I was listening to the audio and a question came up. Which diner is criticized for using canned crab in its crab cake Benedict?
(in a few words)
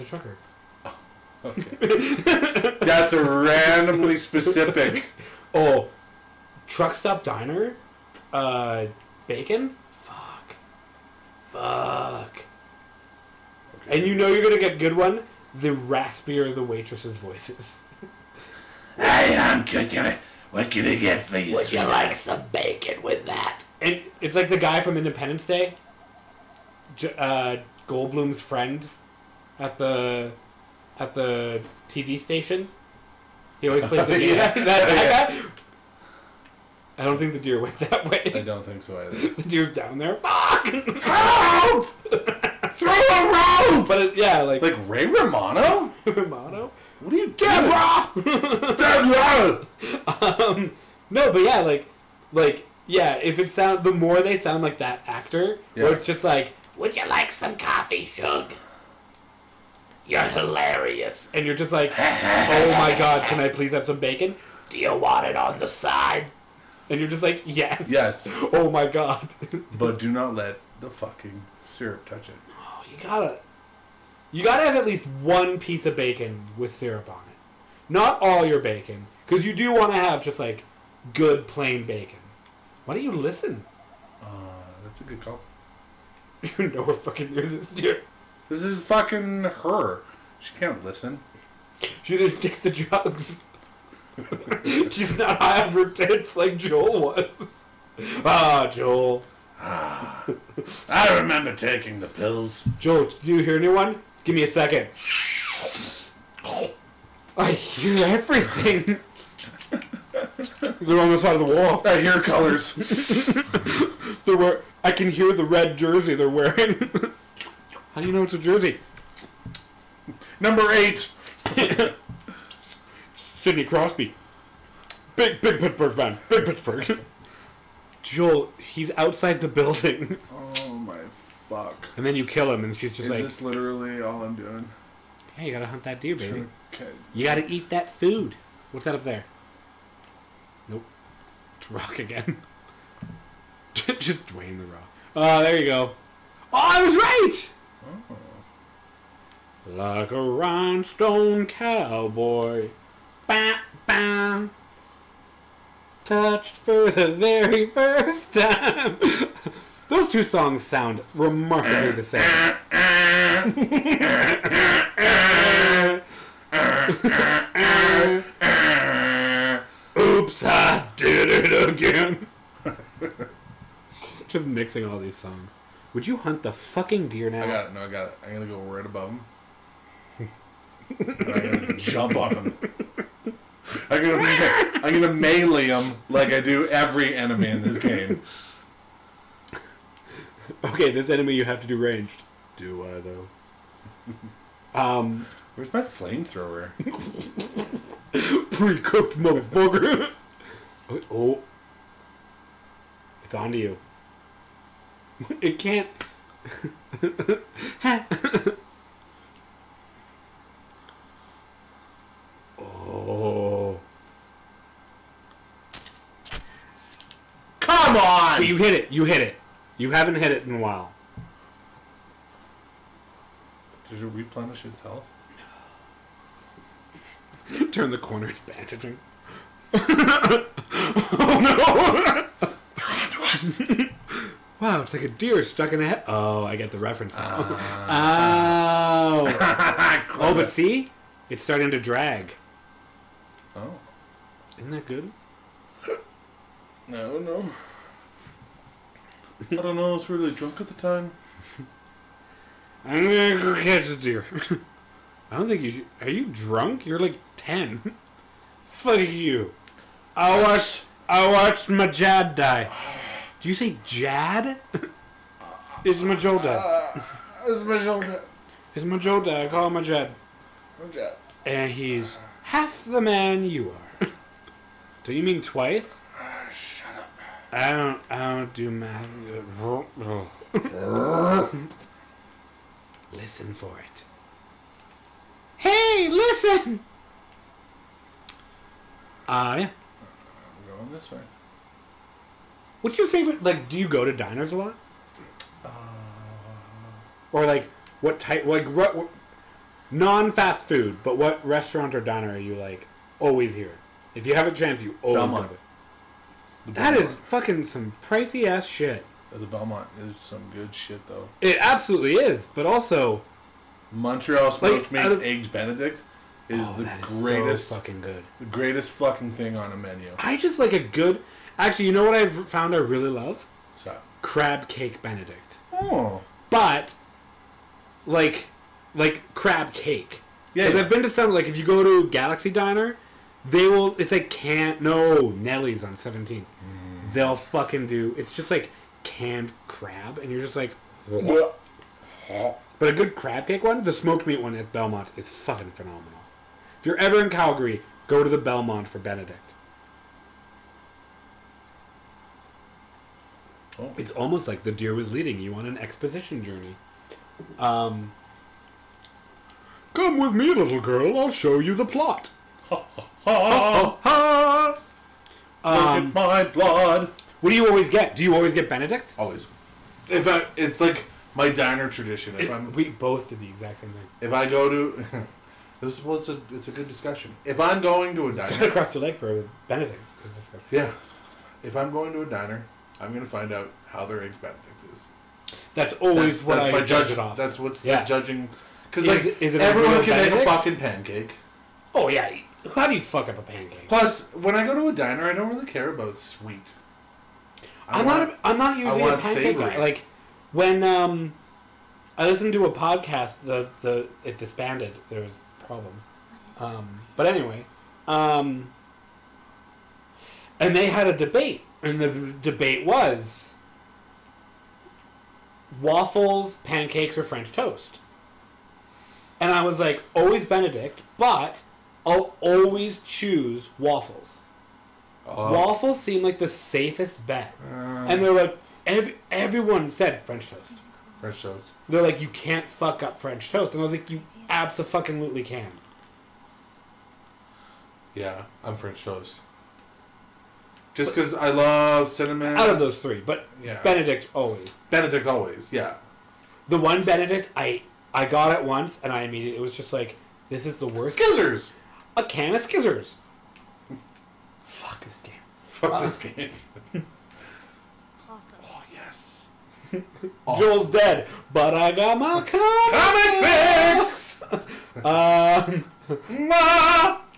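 Galaxie Diner.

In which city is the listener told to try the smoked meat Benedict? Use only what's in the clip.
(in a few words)
Calgary.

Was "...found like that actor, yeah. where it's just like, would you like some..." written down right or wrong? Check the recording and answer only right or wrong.
wrong.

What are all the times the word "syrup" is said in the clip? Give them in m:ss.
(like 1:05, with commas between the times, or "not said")
1:11, 1:16.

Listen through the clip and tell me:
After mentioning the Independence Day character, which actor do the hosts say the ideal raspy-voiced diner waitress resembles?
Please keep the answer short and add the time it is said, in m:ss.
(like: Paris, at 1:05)
Ray Romano, at 0:44.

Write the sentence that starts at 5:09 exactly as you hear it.
The Belmont is some good shit, though.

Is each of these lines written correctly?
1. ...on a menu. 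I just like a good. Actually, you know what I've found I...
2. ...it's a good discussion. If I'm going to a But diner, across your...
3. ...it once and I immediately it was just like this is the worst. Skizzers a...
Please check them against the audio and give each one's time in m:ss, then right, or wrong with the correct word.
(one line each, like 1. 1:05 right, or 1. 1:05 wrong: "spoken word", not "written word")
1. 5:19 right
2. 6:16 wrong: "Cut", not "But"
3. 7:28 right.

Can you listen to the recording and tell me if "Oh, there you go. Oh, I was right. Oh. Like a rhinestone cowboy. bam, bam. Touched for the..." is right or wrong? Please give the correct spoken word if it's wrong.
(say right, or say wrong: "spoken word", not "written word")
right.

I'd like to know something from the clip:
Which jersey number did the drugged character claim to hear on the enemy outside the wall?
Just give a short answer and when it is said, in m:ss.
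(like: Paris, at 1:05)
8, at 2:00.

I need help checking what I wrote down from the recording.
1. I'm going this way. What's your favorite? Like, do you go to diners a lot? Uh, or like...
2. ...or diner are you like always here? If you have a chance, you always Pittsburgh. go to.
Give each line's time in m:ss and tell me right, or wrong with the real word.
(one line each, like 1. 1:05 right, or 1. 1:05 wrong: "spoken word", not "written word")
1. 4:49 right
2. 5:01 wrong: "Belmont", not "Pittsburgh".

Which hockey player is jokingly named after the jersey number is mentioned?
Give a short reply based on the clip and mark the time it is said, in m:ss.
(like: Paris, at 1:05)
Sidney Crosby, at 2:03.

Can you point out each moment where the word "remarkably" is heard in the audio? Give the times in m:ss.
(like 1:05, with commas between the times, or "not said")
2:41.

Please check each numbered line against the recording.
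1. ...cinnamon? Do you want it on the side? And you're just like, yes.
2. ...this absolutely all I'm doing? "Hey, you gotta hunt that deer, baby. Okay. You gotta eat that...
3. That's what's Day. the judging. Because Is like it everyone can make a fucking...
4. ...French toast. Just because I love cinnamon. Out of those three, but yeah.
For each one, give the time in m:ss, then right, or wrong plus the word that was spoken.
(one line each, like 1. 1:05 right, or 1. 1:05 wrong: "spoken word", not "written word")
1. 1:03 wrong: "bacon", not "cinnamon"
2. 2:13 wrong: "literally", not "absolutely"
3. 6:27 wrong: "Yeah", not "Day"
4. 7:18 right.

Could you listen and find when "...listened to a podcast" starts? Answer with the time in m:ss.
6:42.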